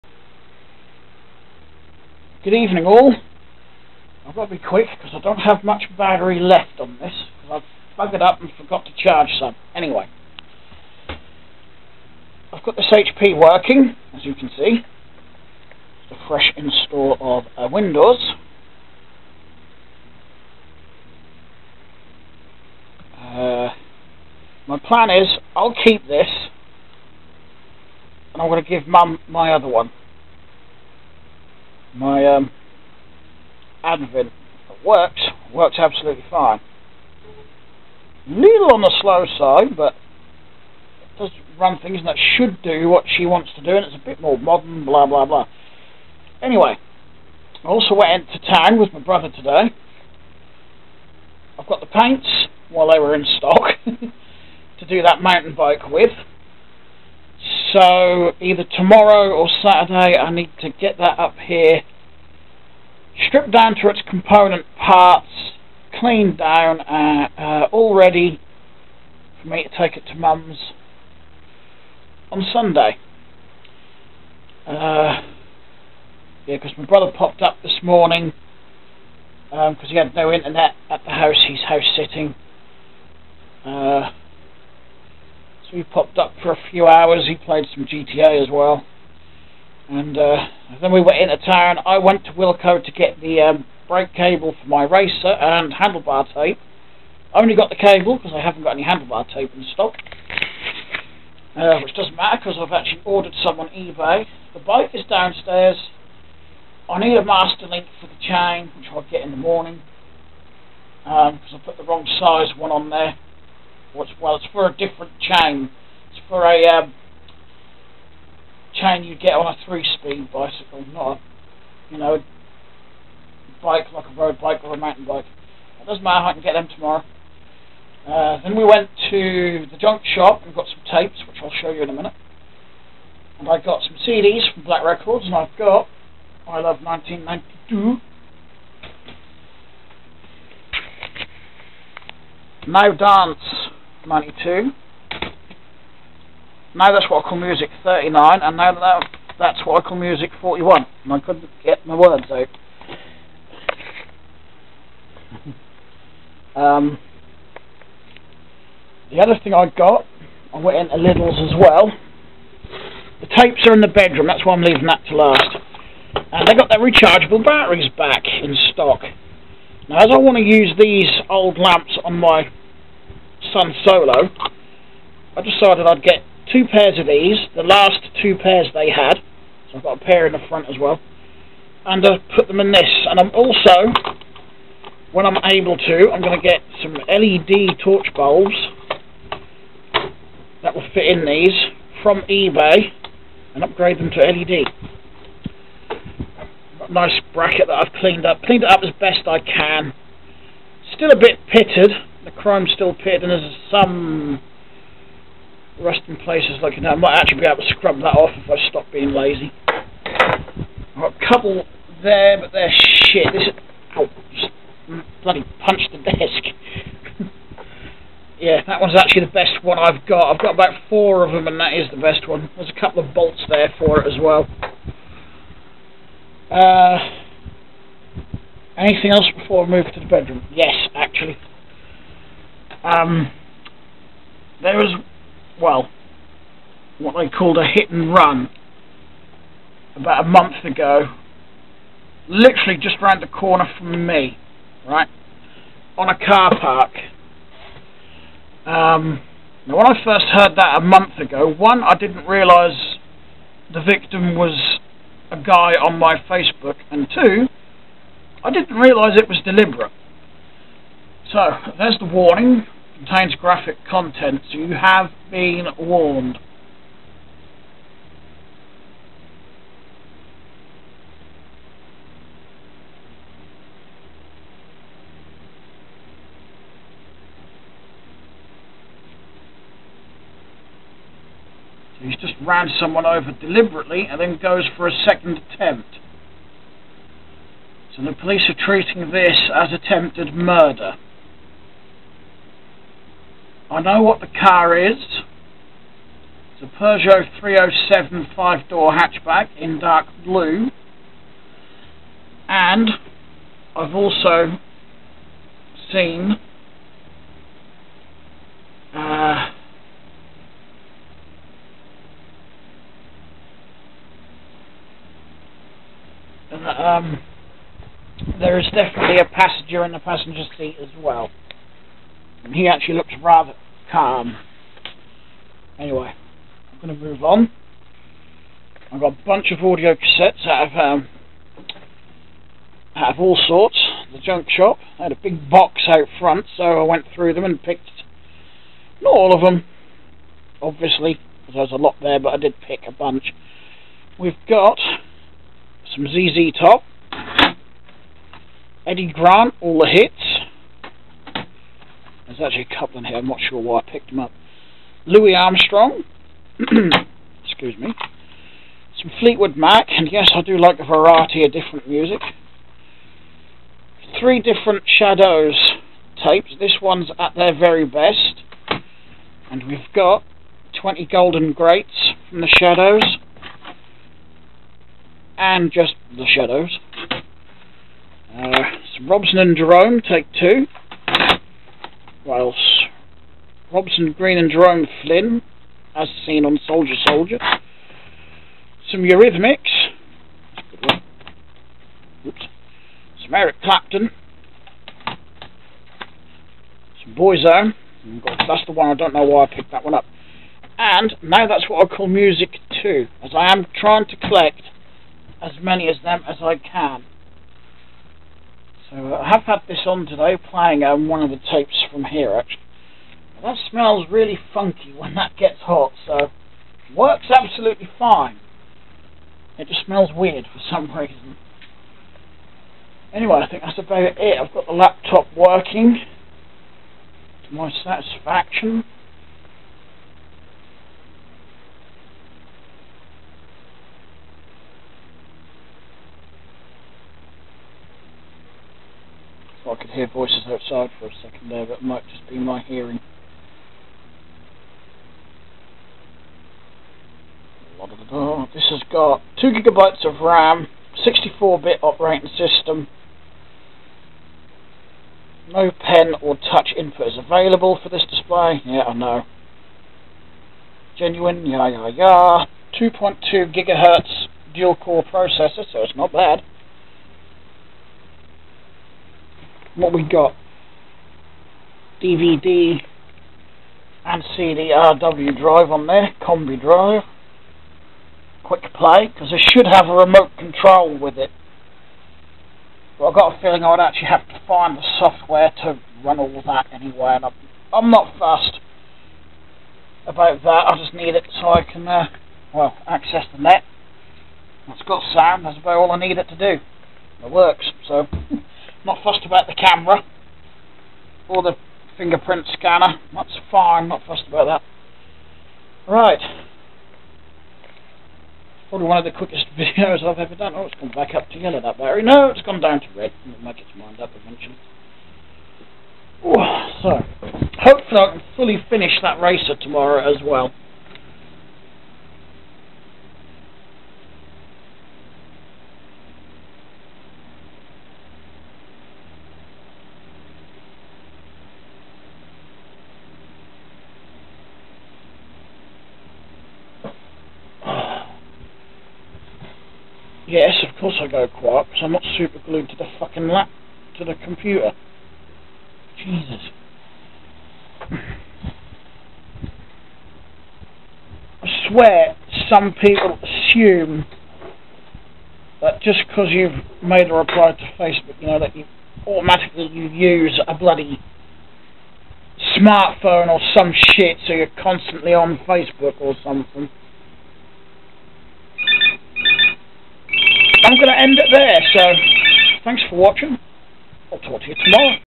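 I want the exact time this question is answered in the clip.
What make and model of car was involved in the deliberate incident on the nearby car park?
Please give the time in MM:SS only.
04:56.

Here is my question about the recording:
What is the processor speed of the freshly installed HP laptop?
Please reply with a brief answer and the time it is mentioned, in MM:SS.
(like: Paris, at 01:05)
2.2 gigahertz, at 07:42.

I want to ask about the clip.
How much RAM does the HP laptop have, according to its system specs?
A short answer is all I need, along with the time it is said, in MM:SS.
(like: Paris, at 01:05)
2 gigabytes, at 07:29.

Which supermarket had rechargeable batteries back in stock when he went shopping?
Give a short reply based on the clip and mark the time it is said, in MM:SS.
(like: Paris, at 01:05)
Lidl's, at 02:40.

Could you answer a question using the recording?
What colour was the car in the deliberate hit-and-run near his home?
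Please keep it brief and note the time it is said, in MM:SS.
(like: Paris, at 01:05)
dark blue, at 04:59.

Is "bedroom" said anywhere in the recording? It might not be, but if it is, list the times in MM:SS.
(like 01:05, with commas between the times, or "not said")
02:43, 03:50.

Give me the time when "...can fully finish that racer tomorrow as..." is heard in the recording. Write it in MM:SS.
08:38.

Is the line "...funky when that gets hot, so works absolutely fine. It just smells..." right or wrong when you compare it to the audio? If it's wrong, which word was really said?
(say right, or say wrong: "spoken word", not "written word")
right.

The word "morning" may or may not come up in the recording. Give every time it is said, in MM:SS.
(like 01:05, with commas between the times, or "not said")
01:17, 01:49.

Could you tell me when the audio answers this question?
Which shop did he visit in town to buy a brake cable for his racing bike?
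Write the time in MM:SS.
01:32.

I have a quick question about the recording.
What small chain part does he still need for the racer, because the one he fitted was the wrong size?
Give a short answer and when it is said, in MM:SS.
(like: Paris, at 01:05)
master link, at 01:47.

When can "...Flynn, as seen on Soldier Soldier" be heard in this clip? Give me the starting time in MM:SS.
06:25.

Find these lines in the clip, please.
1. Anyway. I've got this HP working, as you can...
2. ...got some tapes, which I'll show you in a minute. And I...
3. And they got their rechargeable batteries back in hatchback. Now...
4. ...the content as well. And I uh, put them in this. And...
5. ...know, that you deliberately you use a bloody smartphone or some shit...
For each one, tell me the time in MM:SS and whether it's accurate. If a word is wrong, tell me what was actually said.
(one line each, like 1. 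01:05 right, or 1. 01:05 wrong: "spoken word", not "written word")
1. 00:09 right
2. 02:10 right
3. 02:46 wrong: "stock", not "hatchback"
4. 03:00 wrong: "front", not "content"
5. 09:18 wrong: "automatically", not "deliberately".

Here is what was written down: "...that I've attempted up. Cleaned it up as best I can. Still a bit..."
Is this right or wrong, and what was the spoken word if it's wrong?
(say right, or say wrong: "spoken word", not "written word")
wrong: "cleaned", not "attempted".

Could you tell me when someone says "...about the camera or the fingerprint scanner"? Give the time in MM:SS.
08:19.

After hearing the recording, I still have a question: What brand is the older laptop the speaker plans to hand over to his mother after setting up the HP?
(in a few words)
Advent.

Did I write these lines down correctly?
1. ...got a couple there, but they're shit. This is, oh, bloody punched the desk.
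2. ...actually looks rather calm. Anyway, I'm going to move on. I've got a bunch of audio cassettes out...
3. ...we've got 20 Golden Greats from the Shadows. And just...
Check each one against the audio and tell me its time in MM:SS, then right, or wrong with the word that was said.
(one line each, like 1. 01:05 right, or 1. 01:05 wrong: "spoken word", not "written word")
1. 03:31 right
2. 05:22 right
3. 06:09 right.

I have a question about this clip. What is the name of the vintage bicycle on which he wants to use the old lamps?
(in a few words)
Sun Solo.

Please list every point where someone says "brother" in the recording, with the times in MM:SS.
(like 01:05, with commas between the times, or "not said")
00:48, 01:16.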